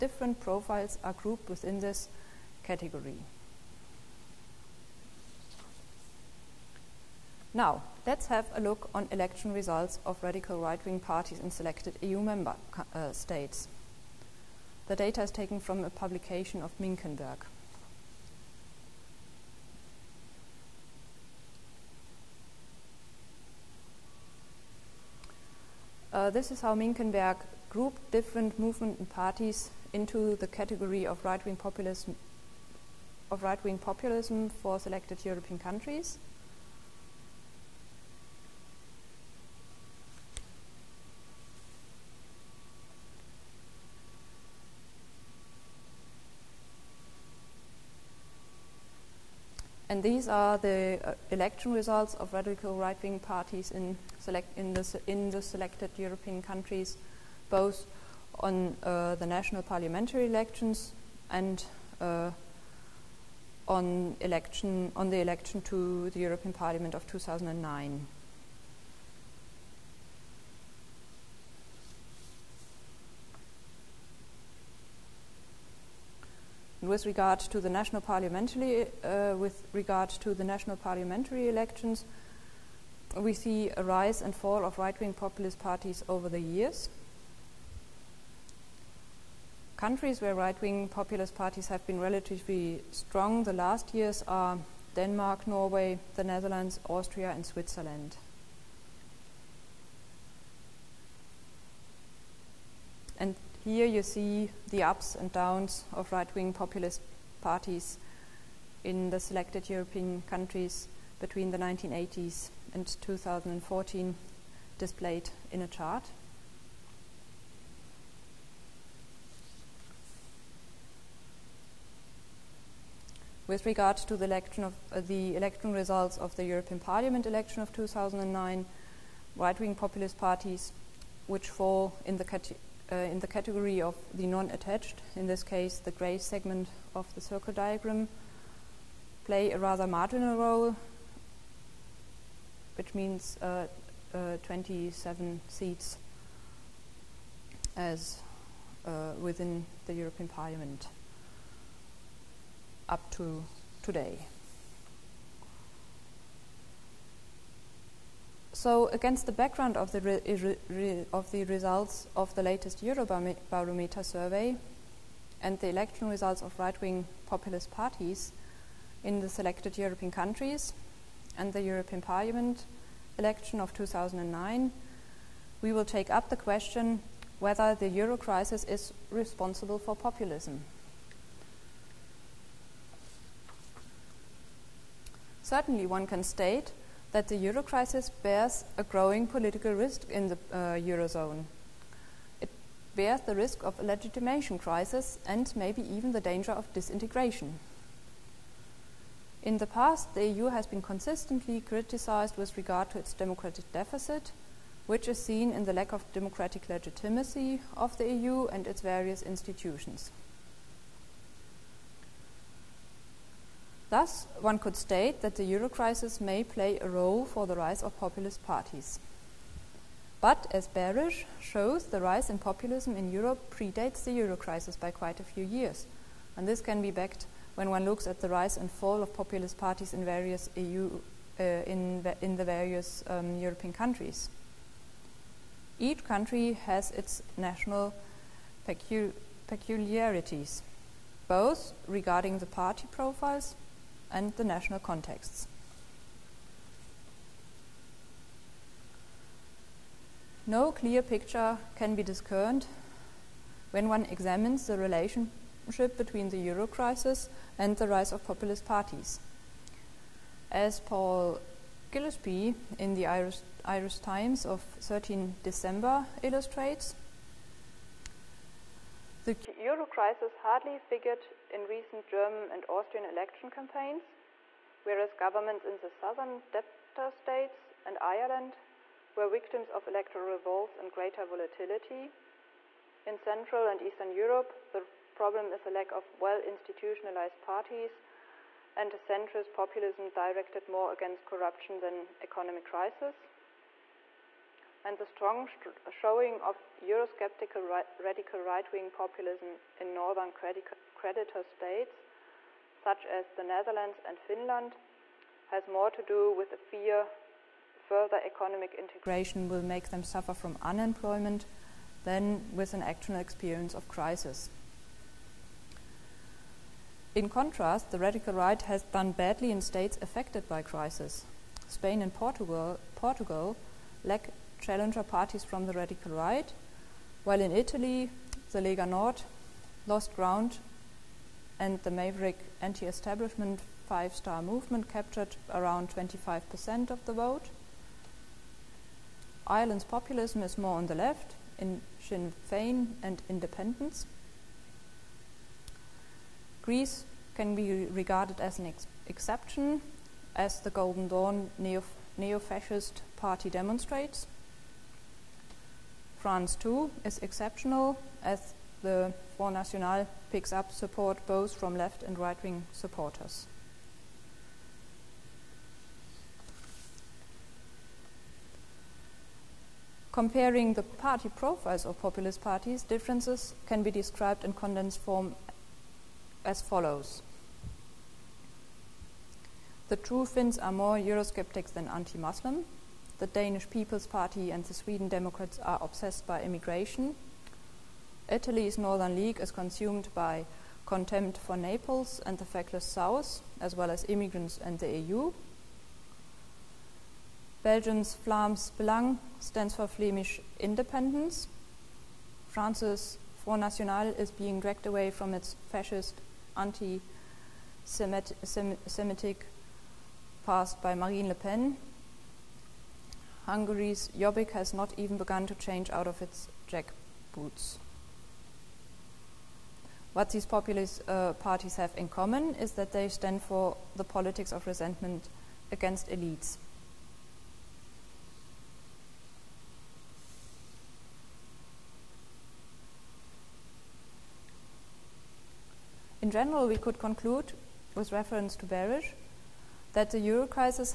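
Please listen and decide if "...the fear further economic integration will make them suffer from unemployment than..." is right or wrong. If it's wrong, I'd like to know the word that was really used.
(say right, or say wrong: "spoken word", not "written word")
right.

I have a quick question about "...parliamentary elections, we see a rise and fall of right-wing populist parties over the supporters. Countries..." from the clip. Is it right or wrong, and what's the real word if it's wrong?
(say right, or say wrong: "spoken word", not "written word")
wrong: "years", not "supporters".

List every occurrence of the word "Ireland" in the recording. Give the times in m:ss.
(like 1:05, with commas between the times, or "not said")
4:37, 5:39.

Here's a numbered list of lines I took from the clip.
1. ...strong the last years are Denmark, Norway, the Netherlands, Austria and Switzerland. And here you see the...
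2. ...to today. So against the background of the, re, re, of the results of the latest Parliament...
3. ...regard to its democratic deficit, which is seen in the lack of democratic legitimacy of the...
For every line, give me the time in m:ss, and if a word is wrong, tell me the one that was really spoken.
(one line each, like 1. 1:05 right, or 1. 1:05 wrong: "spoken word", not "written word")
1. 1:32 right
2. 2:33 wrong: "Eurobarometer", not "Parliament"
3. 3:22 right.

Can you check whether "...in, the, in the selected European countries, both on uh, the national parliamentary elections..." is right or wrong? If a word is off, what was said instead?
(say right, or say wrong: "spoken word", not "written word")
right.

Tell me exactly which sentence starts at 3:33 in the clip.
Thus, one could state that the euro crisis may play a role for the rise of populist parties.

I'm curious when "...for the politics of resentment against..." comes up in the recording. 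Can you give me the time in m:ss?
7:03.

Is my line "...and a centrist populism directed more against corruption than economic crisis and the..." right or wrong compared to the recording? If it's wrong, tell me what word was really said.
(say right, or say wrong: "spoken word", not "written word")
right.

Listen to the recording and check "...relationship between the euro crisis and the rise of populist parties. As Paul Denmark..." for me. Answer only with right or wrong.
wrong.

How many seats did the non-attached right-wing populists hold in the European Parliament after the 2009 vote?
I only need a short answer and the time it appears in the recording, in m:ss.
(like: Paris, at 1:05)
27, at 2:24.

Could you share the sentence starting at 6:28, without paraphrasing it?
Italy's Northern League is consumed by contempt for Naples and the feckless South, as well as immigrants and the EU.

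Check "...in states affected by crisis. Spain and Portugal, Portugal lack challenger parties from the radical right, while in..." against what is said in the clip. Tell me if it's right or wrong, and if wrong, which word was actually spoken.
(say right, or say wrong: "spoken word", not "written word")
right.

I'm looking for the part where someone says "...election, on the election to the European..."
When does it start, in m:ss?
1:04.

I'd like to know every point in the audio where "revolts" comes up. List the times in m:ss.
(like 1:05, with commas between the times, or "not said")
4:40.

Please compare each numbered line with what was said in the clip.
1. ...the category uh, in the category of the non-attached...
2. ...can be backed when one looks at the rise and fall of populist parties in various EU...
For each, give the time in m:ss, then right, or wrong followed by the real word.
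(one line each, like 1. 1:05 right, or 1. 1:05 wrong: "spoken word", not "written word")
1. 2:12 right
2. 3:46 right.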